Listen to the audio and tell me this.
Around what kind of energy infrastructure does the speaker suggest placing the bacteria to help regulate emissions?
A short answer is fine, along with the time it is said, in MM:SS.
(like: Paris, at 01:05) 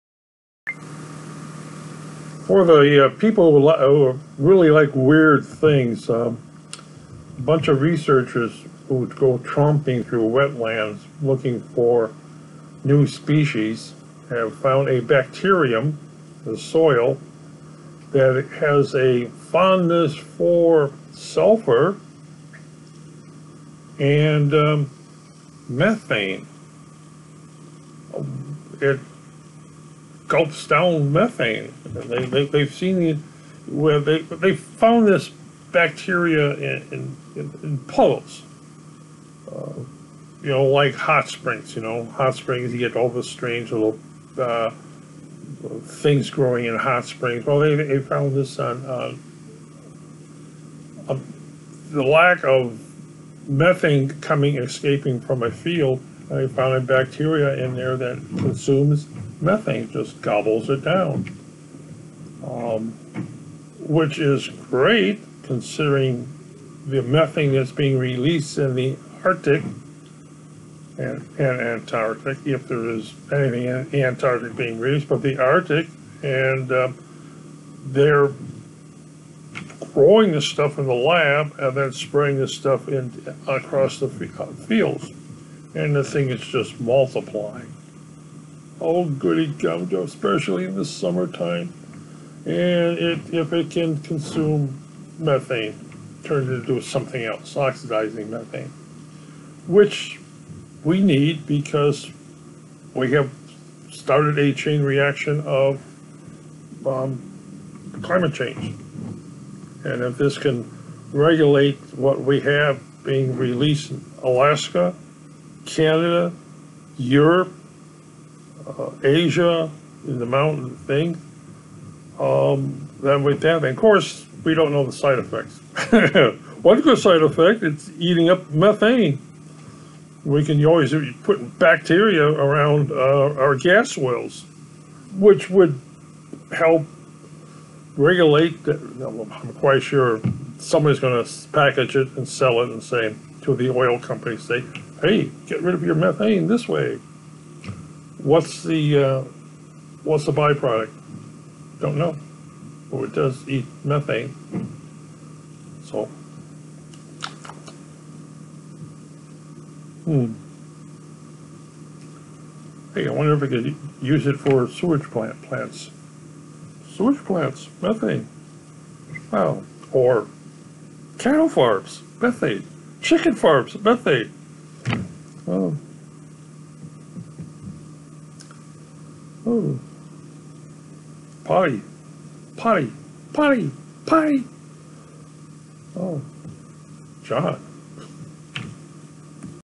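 gas wells, at 02:13.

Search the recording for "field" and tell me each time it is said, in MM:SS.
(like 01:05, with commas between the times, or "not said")
00:55, 01:24.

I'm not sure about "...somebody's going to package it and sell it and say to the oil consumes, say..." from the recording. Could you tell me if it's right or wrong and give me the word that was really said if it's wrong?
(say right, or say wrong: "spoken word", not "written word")
wrong: "companies", not "consumes".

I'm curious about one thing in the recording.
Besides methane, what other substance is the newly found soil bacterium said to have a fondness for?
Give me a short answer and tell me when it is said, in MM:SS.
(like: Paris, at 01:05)
sulfur, at 00:21.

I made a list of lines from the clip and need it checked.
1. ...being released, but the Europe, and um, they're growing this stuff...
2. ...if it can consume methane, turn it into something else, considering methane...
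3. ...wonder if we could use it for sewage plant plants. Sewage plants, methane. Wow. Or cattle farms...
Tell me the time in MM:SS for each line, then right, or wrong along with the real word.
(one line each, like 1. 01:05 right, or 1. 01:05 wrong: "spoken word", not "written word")
1. 01:14 wrong: "Arctic", not "Europe"
2. 01:33 wrong: "oxidizing", not "considering"
3. 02:43 right.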